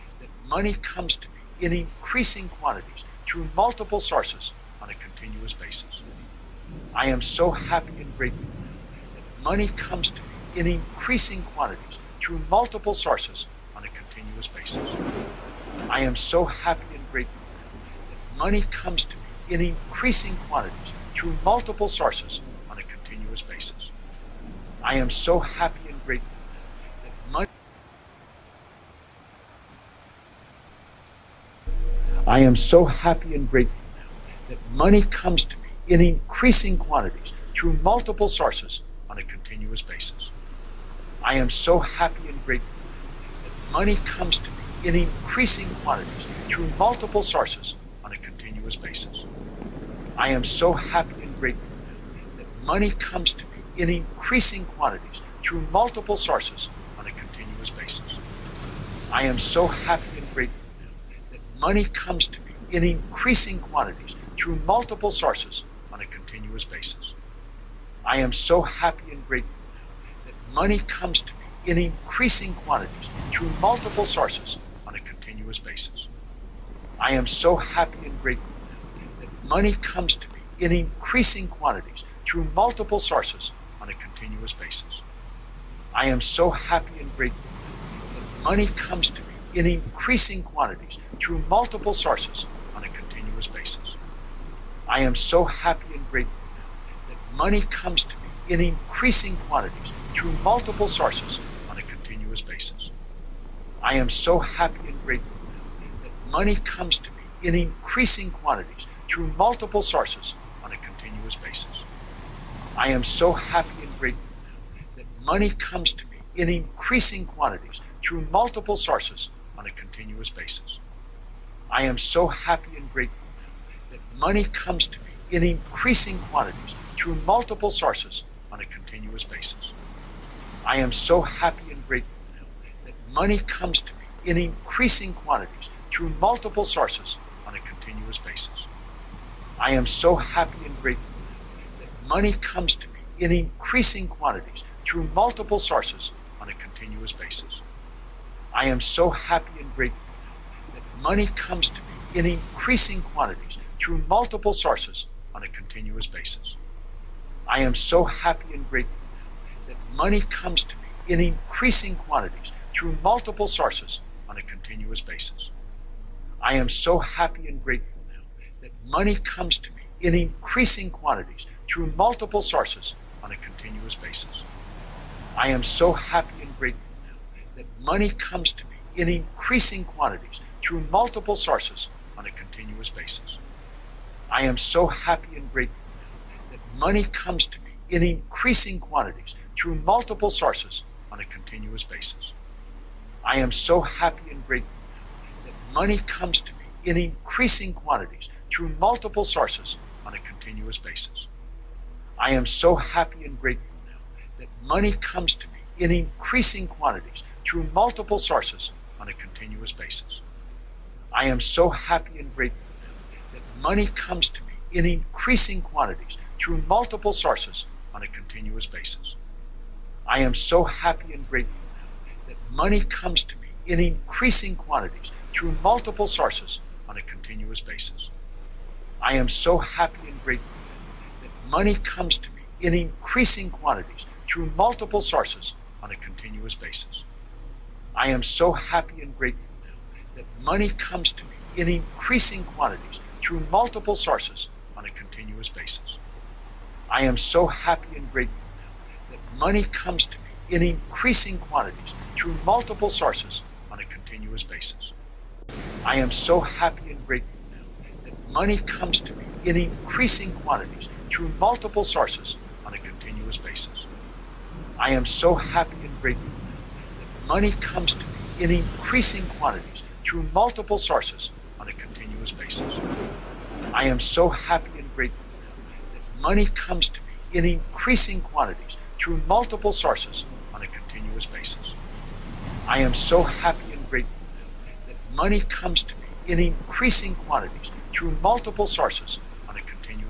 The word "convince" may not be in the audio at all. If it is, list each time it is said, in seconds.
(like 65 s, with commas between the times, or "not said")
not said.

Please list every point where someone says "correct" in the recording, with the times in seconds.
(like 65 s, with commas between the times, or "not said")
not said.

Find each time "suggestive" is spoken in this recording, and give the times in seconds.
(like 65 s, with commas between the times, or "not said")
not said.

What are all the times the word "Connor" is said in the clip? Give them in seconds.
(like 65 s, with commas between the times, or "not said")
not said.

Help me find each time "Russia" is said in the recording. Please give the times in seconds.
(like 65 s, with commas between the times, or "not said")
not said.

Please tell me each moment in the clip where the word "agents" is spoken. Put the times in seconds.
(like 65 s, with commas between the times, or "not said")
not said.